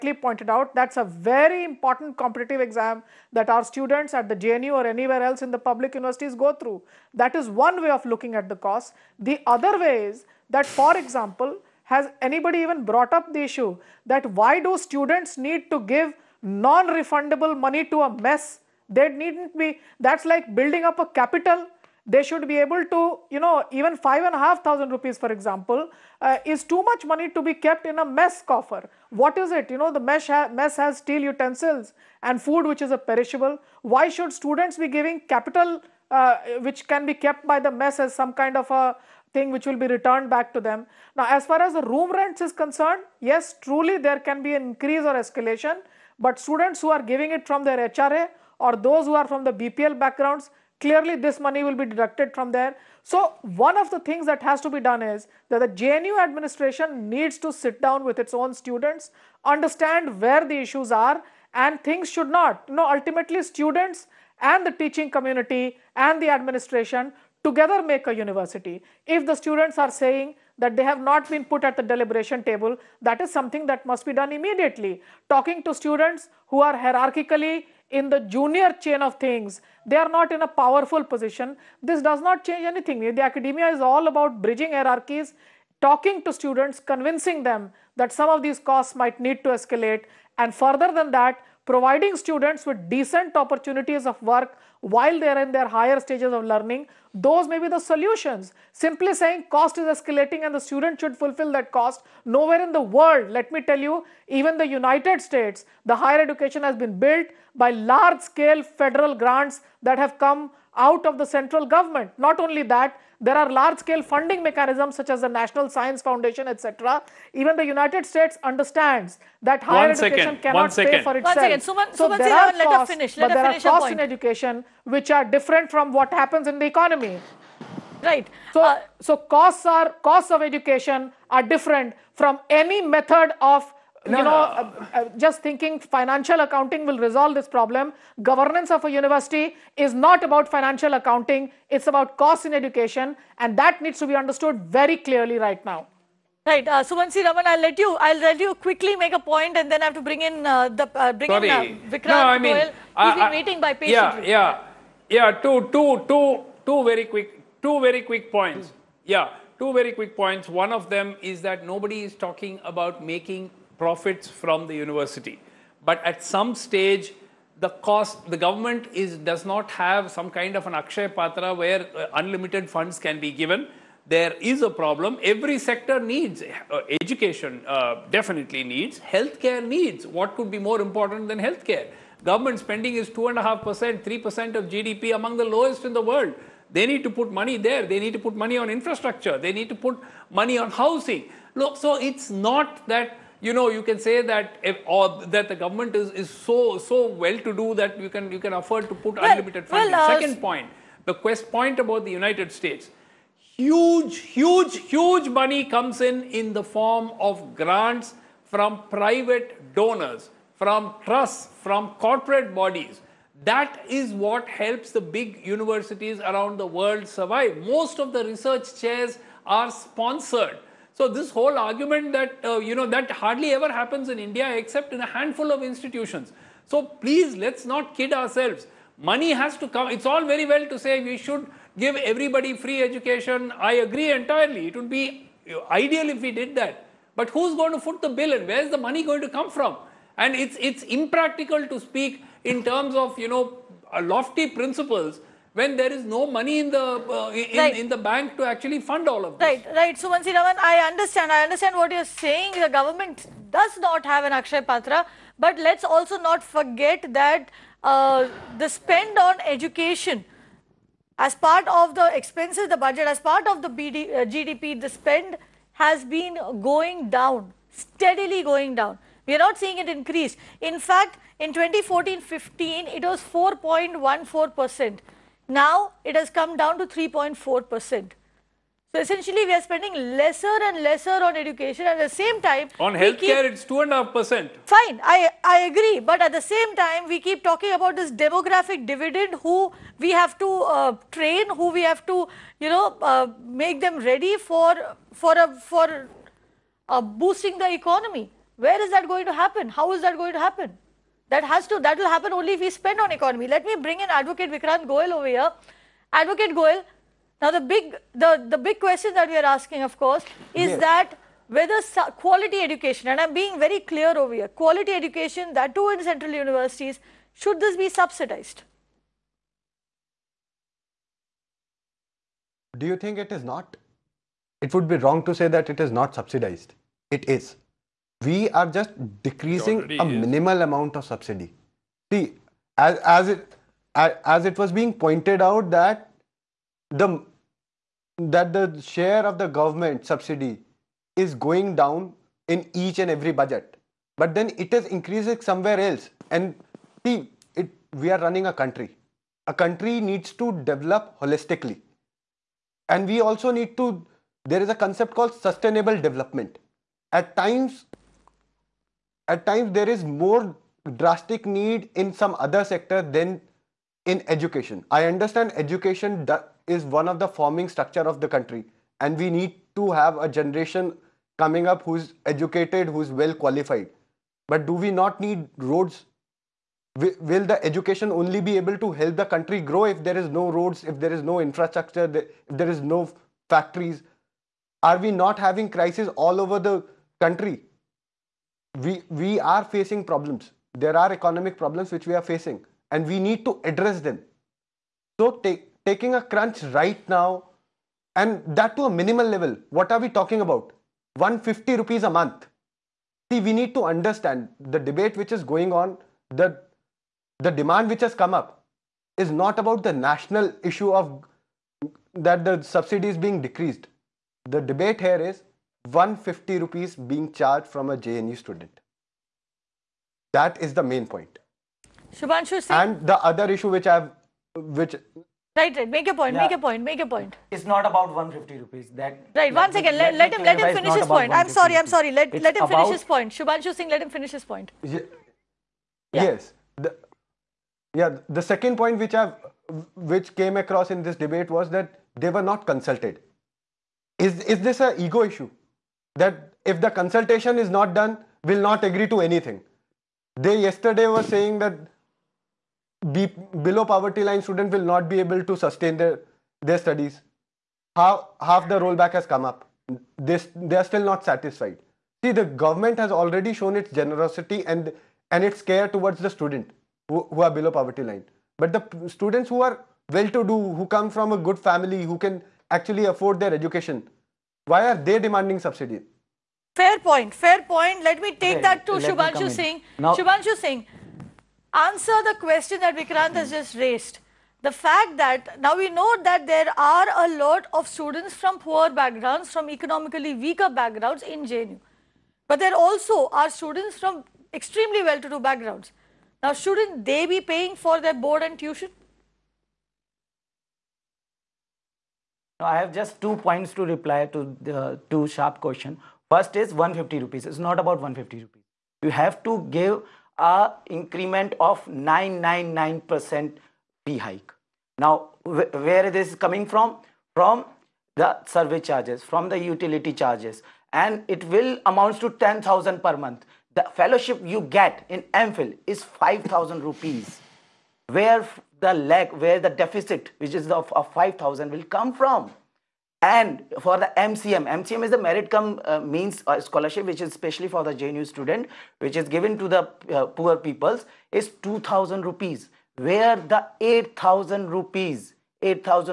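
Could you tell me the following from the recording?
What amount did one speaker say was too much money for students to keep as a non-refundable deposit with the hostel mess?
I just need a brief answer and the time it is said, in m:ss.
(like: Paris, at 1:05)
5,500 rupees, at 0:23.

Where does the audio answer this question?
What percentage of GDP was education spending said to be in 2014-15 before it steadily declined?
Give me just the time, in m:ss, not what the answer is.
4:33.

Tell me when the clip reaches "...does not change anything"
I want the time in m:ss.
1:22.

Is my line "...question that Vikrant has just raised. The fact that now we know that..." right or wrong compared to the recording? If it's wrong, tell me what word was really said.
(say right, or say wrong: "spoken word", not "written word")
right.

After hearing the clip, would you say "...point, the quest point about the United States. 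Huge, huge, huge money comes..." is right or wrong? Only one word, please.
right.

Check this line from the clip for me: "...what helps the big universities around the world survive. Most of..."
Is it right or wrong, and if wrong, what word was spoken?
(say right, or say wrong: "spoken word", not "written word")
right.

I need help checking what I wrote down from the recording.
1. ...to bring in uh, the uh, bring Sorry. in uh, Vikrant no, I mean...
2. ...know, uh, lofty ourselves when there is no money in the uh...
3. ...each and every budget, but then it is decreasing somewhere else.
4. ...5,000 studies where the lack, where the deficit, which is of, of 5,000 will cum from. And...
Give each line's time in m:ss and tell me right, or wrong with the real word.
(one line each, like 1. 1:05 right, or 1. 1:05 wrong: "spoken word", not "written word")
1. 2:29 right
2. 4:03 wrong: "principles", not "ourselves"
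3. 5:42 wrong: "increasing", not "decreasing"
4. 8:46 wrong: "rupees", not "studies".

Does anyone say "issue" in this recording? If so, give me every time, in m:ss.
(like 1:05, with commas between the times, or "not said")
0:13, 1:00, 6:50, 7:03, 7:25.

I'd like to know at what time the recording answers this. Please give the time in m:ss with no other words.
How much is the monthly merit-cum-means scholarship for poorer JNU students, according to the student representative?
9:01.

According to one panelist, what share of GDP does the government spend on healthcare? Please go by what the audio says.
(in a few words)
2.5% to 3%.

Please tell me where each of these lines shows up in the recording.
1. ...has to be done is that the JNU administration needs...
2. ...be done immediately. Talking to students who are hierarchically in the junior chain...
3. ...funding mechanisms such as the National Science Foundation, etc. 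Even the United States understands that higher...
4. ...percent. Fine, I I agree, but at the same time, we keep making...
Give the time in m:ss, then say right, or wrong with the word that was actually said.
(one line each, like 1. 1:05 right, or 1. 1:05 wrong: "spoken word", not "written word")
1. 0:54 right
2. 1:14 right
3. 1:54 right
4. 4:44 wrong: "talking", not "making".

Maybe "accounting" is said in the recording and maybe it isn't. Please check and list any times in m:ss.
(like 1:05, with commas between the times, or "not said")
2:16, 2:20.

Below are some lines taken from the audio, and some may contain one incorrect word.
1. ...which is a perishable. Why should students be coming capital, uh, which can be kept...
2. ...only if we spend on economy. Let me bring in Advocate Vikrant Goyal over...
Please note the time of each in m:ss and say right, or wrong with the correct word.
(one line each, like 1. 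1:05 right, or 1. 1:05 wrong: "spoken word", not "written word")
1. 0:32 wrong: "giving", not "coming"
2. 5:02 right.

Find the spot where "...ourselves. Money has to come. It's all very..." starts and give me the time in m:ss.
3:48.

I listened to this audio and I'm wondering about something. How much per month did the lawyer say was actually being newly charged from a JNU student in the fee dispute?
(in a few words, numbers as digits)
150 rupees.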